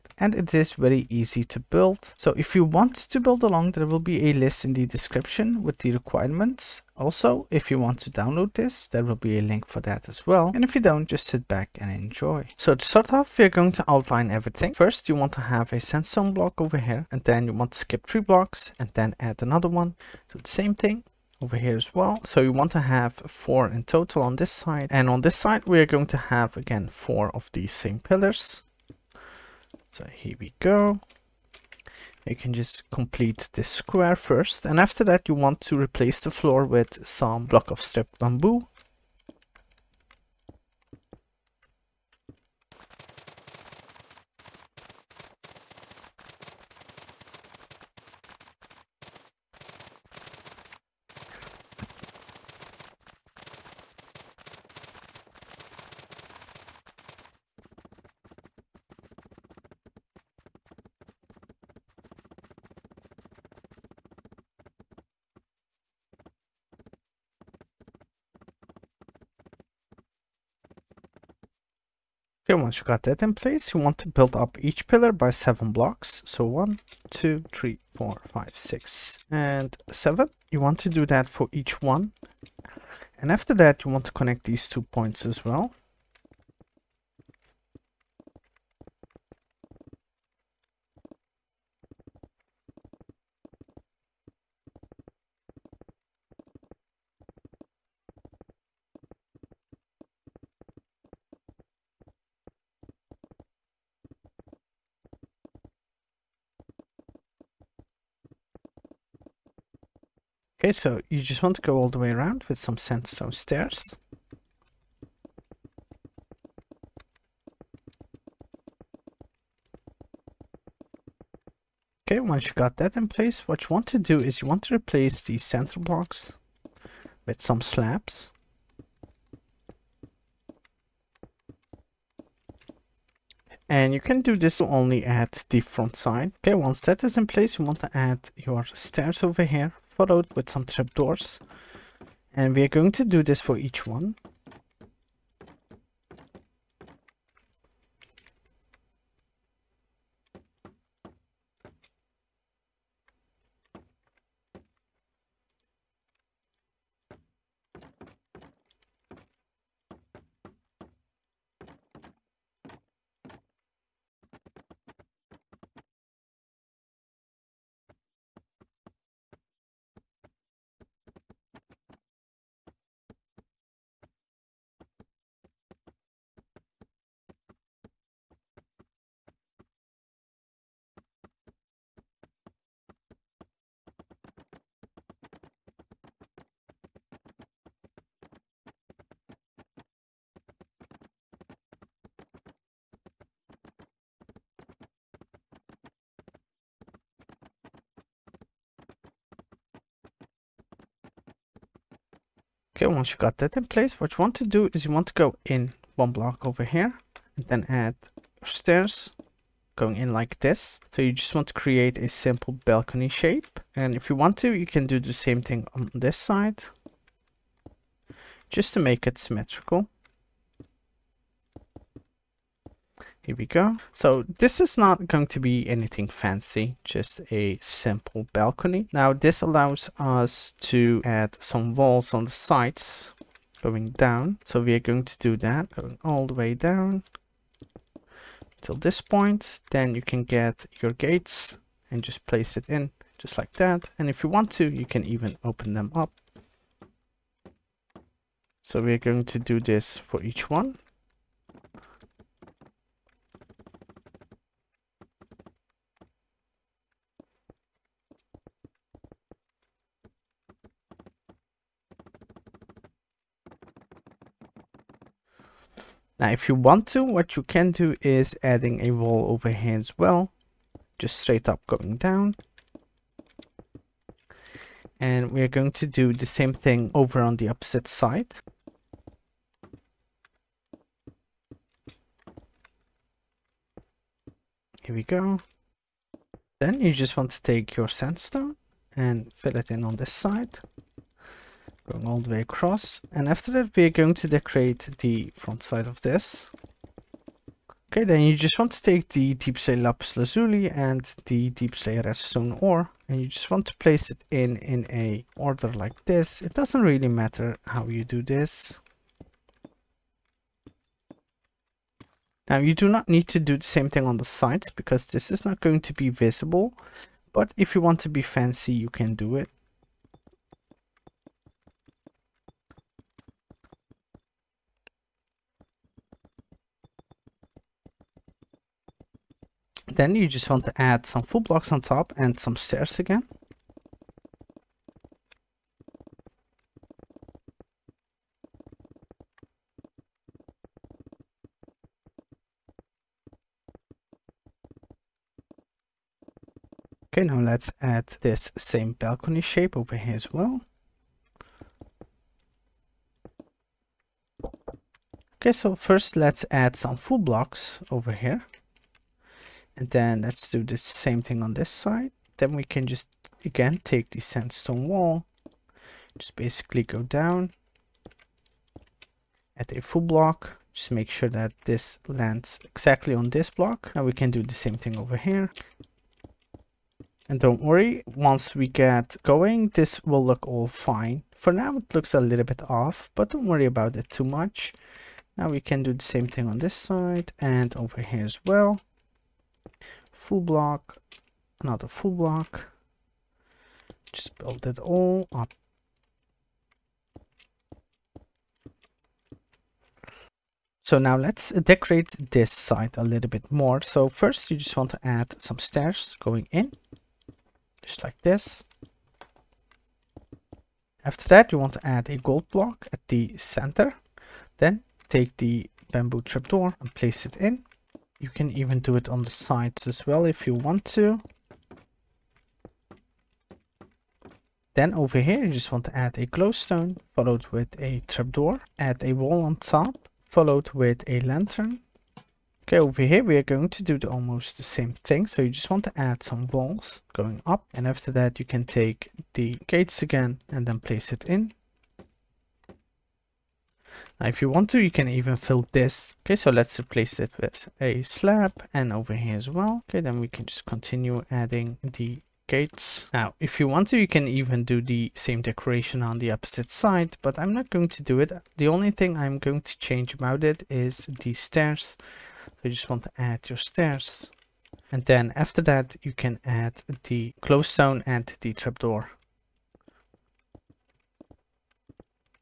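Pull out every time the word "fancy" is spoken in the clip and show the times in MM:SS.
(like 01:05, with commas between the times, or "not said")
03:46, 05:18.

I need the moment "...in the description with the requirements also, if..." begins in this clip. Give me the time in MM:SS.
00:04.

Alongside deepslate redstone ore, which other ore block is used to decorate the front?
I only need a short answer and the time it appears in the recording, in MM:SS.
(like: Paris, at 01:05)
deepslate lapis lazuli, at 04:59.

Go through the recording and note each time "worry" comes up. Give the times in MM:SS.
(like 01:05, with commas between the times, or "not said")
06:17, 06:23.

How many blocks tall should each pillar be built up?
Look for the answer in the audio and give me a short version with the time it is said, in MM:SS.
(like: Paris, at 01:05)
7, at 01:15.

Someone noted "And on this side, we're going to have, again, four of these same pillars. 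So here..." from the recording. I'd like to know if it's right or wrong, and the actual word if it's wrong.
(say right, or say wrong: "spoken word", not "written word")
right.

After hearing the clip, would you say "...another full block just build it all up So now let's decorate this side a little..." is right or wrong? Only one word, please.
right.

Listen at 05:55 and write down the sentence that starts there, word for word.
Okay, so first let's add some full blocks over here.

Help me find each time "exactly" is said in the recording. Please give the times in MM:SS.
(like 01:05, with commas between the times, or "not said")
06:12.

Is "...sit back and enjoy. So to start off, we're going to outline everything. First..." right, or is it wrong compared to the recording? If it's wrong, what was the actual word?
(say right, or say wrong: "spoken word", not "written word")
right.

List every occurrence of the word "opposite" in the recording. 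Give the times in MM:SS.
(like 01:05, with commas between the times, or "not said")
04:37, 07:36.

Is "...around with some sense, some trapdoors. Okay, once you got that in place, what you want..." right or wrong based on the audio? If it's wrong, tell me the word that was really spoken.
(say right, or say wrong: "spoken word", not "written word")
wrong: "stairs", not "trapdoors".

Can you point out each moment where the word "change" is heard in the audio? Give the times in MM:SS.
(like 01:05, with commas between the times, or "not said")
07:39.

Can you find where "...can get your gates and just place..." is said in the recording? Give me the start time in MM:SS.
04:00.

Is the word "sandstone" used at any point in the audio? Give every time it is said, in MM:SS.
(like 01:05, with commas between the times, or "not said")
00:15, 04:47, 06:04.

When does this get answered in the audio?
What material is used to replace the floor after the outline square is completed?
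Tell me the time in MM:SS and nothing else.
00:37.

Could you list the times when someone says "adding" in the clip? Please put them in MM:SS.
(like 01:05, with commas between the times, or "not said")
04:28, 07:31.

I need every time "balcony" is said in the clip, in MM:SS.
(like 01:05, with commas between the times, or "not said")
03:32, 03:48, 05:48.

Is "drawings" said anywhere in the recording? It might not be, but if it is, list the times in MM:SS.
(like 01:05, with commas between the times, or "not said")
not said.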